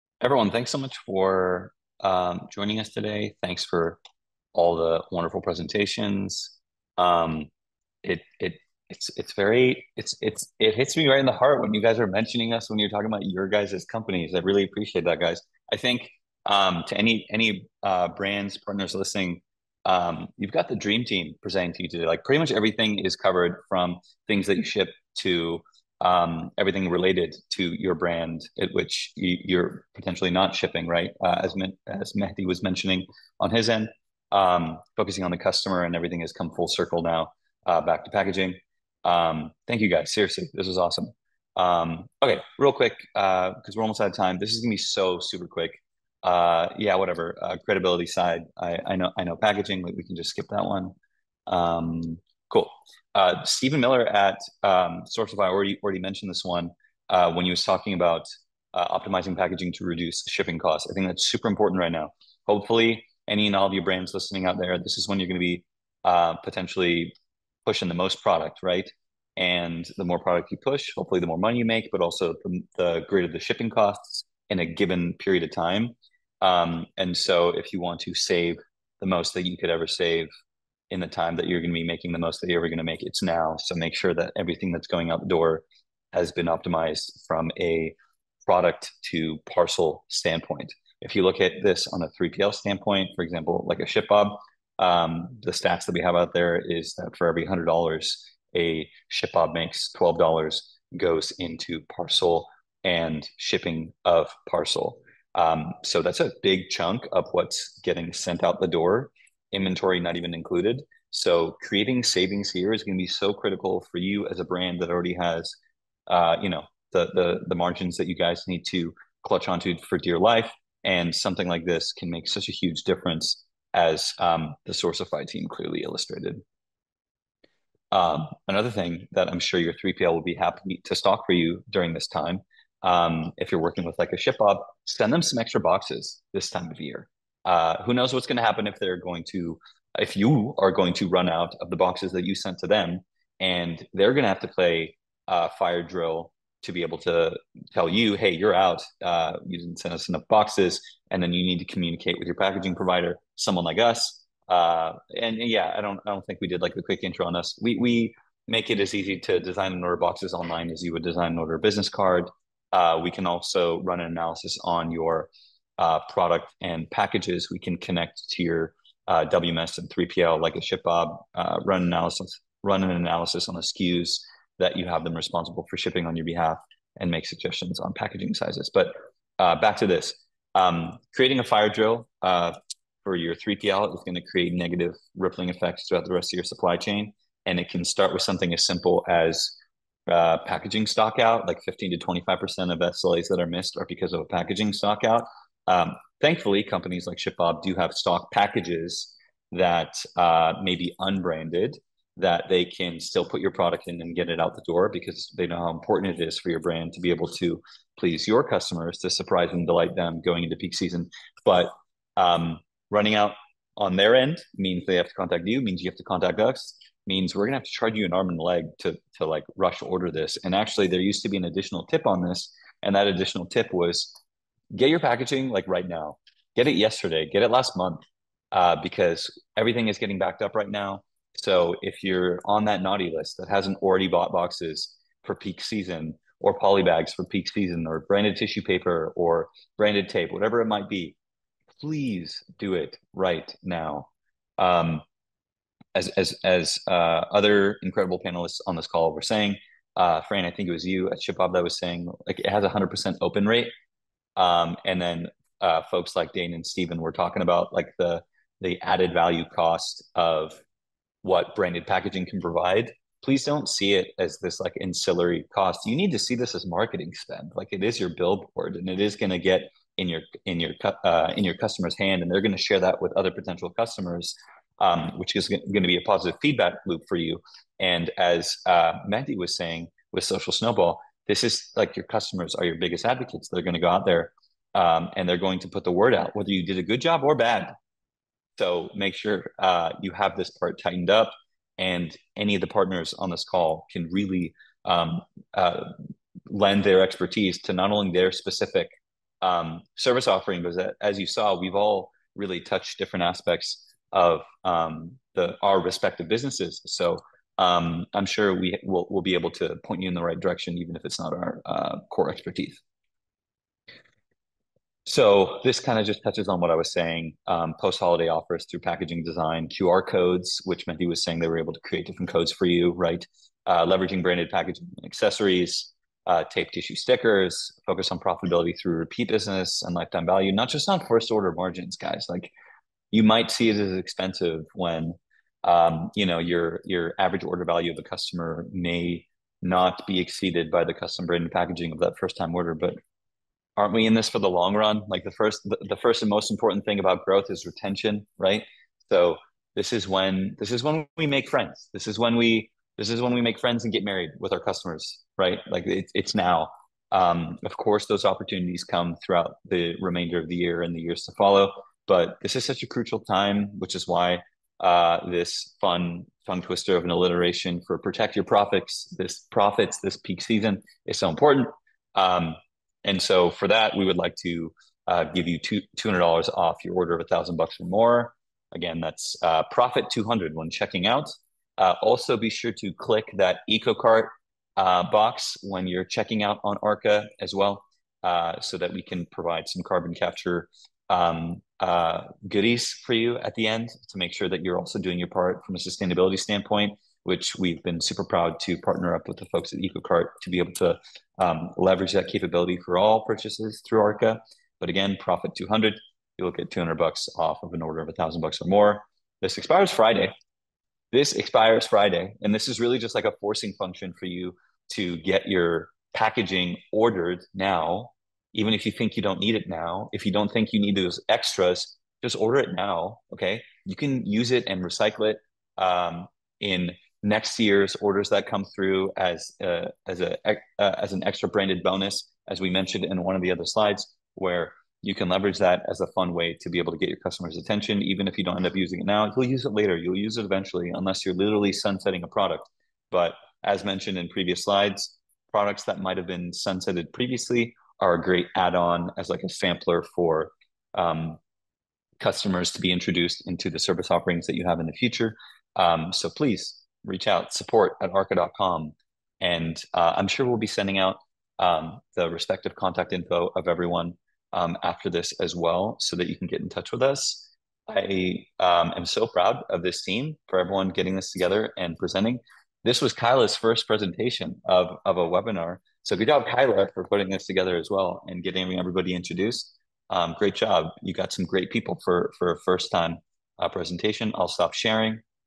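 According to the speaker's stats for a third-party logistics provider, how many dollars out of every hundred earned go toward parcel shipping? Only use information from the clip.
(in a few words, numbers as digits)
$12.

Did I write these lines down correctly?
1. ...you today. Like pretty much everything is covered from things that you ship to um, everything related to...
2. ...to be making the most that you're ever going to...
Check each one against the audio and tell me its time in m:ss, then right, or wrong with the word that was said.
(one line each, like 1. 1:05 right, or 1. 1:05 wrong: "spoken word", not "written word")
1. 0:21 right
2. 1:21 right.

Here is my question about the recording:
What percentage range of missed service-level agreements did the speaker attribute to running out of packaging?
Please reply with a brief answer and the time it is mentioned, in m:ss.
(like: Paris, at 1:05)
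15 to 25%, at 3:11.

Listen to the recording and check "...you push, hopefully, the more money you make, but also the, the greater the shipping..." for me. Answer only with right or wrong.
right.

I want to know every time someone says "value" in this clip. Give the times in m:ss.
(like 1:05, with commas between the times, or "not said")
4:19, 5:30, 5:37.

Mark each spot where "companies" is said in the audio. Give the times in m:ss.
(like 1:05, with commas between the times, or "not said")
0:13, 3:16.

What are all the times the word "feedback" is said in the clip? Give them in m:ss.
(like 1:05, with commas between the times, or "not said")
4:36.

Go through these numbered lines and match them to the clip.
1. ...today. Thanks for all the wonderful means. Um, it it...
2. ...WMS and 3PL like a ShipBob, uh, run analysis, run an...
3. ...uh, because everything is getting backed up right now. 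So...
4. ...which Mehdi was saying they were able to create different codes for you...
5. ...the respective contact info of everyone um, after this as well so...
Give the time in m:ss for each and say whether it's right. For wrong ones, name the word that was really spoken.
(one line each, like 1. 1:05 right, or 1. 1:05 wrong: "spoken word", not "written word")
1. 0:02 wrong: "presentations", not "means"
2. 2:49 right
3. 3:48 right
4. 5:20 right
5. 7:42 right.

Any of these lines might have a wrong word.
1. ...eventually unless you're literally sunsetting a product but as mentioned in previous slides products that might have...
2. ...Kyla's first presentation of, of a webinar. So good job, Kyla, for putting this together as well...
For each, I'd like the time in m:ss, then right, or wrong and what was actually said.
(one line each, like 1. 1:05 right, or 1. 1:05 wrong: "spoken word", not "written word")
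1. 7:20 right
2. 7:53 right.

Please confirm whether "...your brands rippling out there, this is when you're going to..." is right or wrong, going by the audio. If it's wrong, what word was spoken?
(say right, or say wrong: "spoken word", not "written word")
wrong: "listening", not "rippling".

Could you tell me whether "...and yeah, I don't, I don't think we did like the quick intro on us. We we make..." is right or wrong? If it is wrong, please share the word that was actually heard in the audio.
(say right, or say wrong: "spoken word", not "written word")
right.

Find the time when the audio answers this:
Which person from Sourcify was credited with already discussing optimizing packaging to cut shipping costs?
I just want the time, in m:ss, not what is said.
0:53.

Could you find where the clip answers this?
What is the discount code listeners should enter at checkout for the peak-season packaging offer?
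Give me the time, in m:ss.
6:19.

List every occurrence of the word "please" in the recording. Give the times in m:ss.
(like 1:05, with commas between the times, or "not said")
3:27, 4:01, 4:23, 7:36.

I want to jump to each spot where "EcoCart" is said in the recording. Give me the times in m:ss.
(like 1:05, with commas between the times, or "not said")
6:23, 6:39.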